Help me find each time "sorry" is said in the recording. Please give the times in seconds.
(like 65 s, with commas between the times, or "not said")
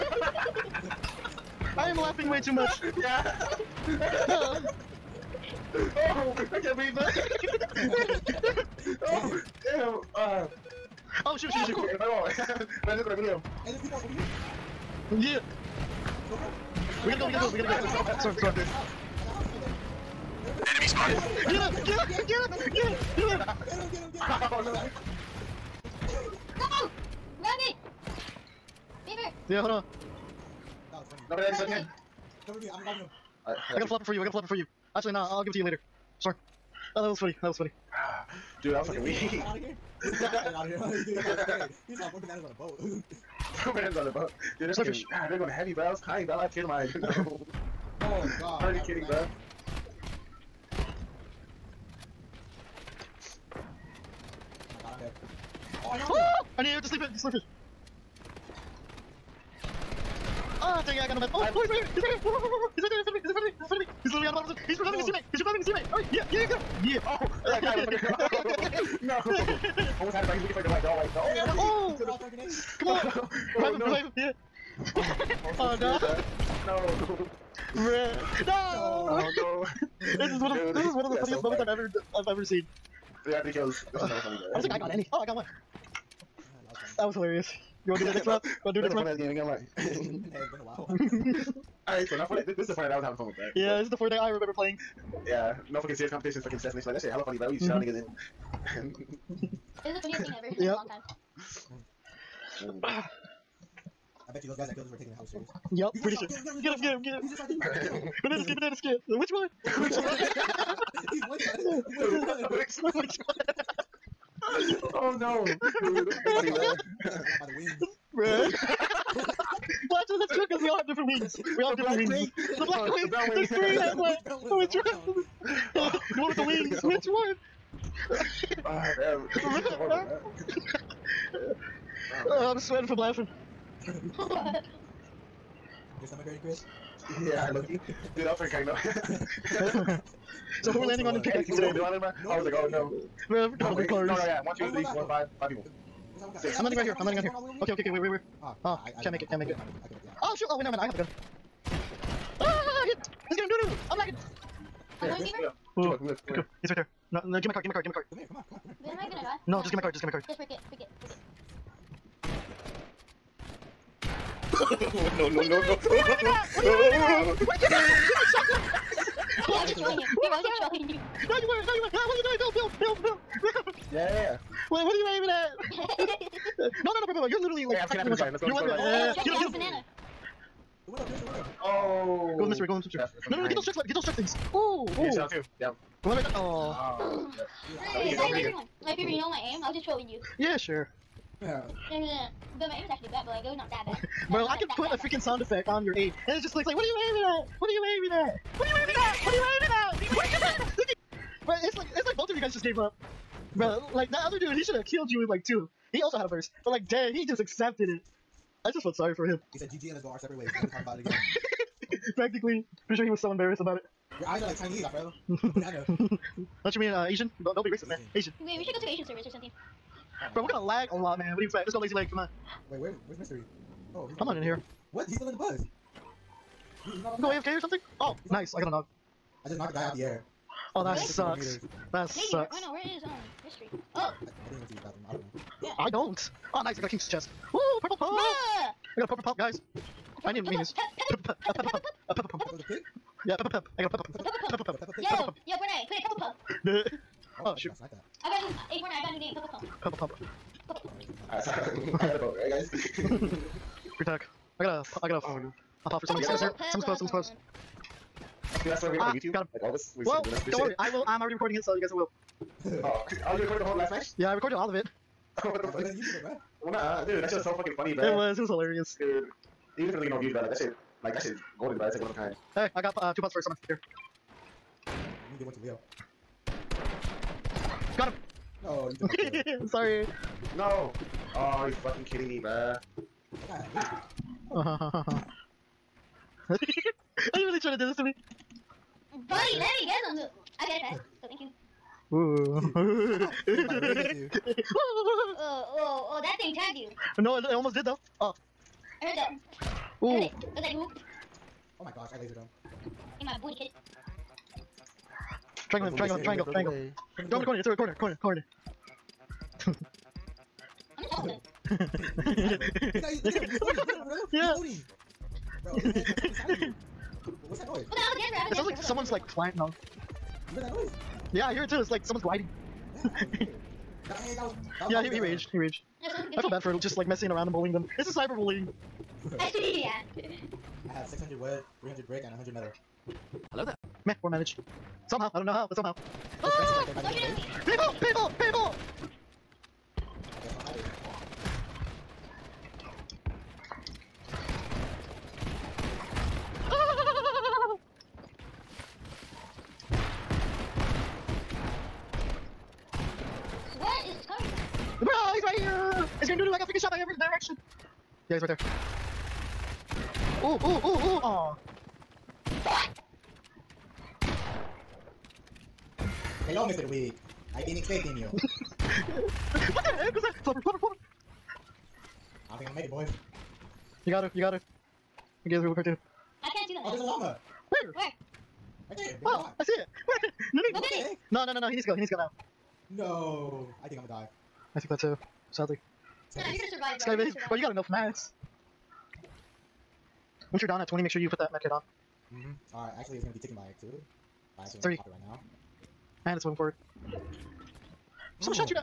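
36 s, 208 s, 279 s.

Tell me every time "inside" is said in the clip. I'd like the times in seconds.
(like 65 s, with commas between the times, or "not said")
107 s, 316 s.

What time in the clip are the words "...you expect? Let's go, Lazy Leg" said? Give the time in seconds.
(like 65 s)
221 s.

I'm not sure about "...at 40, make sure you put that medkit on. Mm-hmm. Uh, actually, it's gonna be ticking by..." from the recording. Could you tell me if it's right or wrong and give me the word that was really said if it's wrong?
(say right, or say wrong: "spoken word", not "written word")
wrong: "20", not "40".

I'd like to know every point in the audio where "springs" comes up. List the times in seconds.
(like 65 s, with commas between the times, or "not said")
not said.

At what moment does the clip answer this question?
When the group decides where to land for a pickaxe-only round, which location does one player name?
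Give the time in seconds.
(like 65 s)
141 s.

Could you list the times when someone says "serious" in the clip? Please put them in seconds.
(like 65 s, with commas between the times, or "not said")
95 s, 105 s.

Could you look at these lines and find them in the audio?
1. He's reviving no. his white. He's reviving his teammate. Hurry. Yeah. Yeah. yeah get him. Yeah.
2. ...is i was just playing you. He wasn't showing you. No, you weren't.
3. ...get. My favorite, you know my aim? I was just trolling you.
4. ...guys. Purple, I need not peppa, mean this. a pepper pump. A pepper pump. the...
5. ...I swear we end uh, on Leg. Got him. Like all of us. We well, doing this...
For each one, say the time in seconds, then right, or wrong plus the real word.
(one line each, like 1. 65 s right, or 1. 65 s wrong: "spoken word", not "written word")
1. 64 s wrong: "teammate", not "white"
2. 169 s wrong: "showing", not "playing"
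3. 188 s right
4. 239 s right
5. 258 s wrong: "YouTube", not "Leg".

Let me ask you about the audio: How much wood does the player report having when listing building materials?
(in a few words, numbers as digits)
600.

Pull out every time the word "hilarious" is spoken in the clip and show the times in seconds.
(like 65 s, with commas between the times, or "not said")
87 s, 268 s.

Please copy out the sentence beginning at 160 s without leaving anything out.
Just break it, break it, break it.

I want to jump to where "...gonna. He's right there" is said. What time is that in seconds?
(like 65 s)
156 s.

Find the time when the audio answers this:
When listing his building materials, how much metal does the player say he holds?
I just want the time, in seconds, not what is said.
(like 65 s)
332 s.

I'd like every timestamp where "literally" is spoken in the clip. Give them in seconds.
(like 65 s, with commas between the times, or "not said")
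64 s, 177 s.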